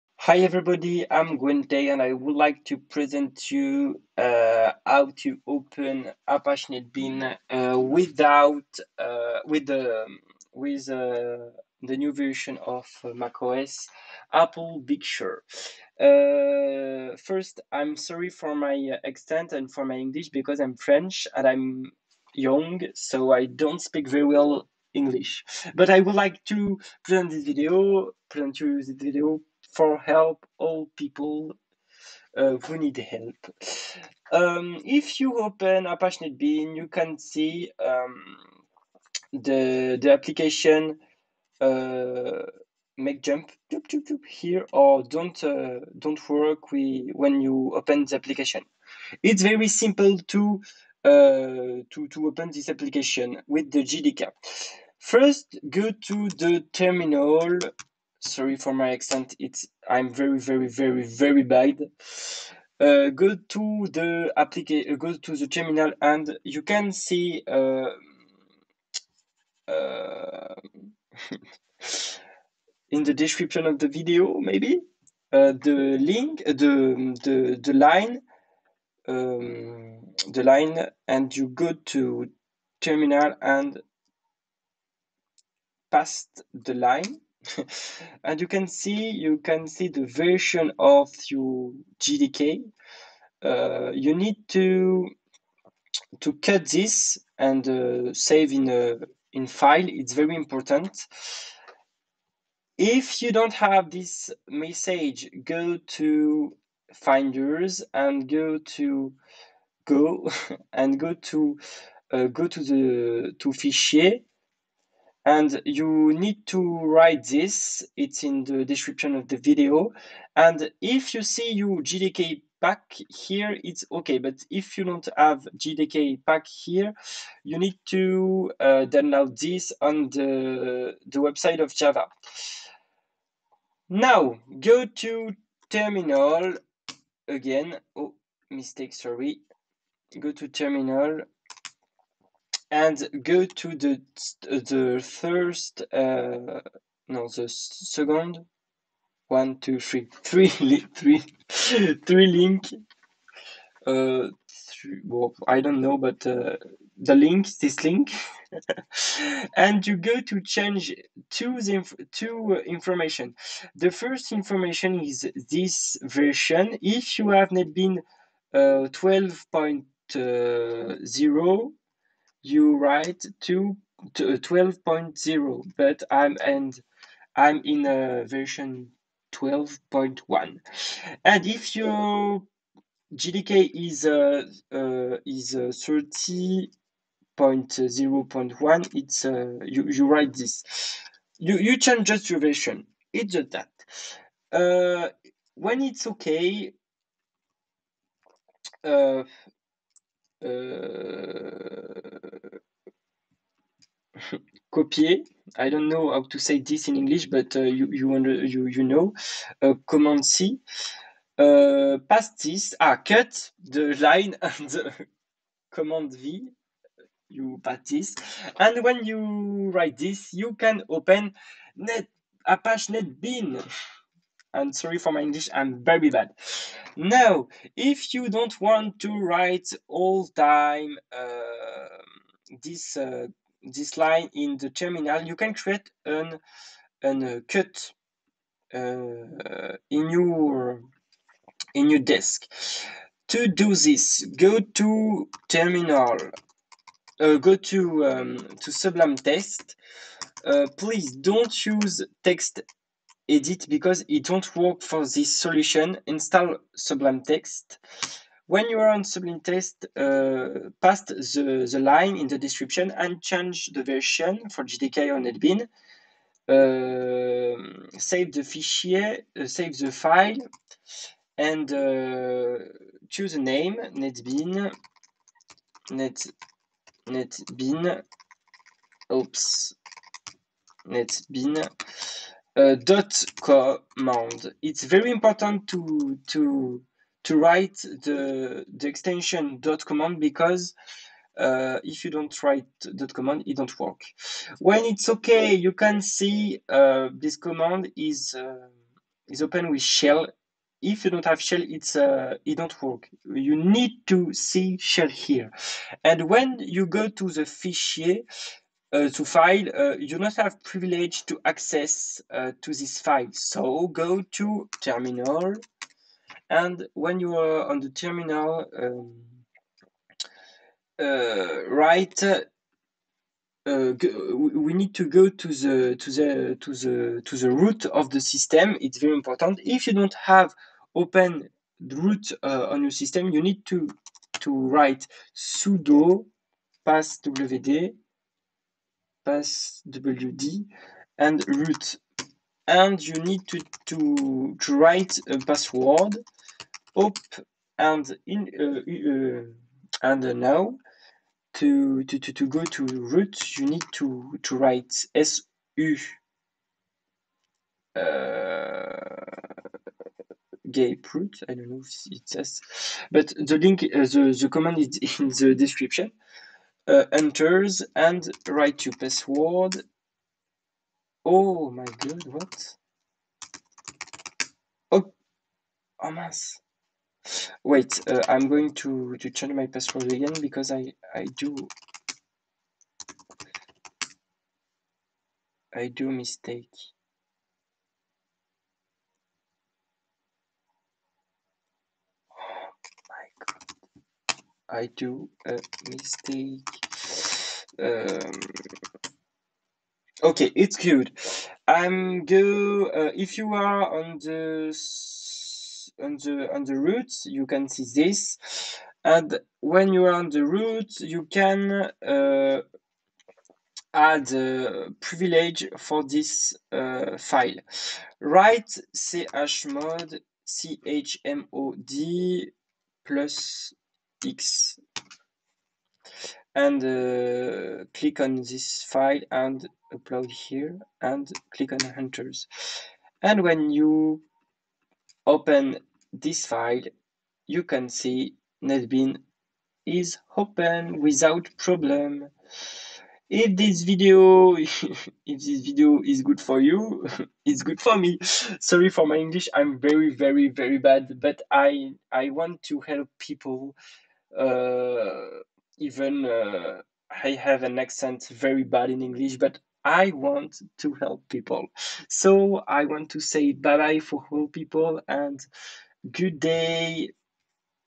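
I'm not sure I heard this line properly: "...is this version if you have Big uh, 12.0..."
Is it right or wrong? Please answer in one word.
wrong.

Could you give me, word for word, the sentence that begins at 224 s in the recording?
And sorry for my English, I'm very bad.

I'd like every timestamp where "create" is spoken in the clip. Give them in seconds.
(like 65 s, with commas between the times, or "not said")
235 s.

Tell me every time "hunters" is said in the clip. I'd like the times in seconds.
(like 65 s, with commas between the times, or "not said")
431 s.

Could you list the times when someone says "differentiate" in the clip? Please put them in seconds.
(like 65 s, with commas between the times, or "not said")
not said.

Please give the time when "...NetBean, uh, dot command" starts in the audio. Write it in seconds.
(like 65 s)
280 s.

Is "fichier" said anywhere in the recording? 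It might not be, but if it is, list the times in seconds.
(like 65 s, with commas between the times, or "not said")
113 s, 268 s, 307 s.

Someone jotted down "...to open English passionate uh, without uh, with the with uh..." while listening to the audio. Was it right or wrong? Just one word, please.
wrong.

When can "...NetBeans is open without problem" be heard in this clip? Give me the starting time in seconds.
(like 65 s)
438 s.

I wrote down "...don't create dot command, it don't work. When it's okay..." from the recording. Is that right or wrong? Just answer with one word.
wrong.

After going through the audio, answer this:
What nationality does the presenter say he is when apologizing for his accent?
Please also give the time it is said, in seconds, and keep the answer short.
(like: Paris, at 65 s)
French, at 20 s.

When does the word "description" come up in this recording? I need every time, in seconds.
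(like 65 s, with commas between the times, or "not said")
73 s, 118 s, 262 s, 365 s.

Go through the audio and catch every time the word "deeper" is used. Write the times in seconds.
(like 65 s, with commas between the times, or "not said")
not said.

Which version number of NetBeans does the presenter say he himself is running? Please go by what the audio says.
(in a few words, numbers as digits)
12.1.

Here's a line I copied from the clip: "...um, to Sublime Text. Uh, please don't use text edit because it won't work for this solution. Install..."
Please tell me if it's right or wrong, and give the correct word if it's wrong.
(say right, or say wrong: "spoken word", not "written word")
right.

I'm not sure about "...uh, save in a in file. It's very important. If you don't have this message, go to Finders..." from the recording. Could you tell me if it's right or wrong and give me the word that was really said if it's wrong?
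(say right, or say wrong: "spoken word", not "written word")
right.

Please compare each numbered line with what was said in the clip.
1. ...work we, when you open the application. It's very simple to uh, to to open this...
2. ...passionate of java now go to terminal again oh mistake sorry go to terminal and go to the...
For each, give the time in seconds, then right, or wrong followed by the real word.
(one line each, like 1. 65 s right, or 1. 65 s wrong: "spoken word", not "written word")
1. 46 s right
2. 131 s wrong: "website", not "passionate".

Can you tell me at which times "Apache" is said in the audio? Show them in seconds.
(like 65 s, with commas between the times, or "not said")
6 s, 35 s, 222 s.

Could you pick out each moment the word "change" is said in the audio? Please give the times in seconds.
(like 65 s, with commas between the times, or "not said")
160 s, 191 s, 263 s, 379 s.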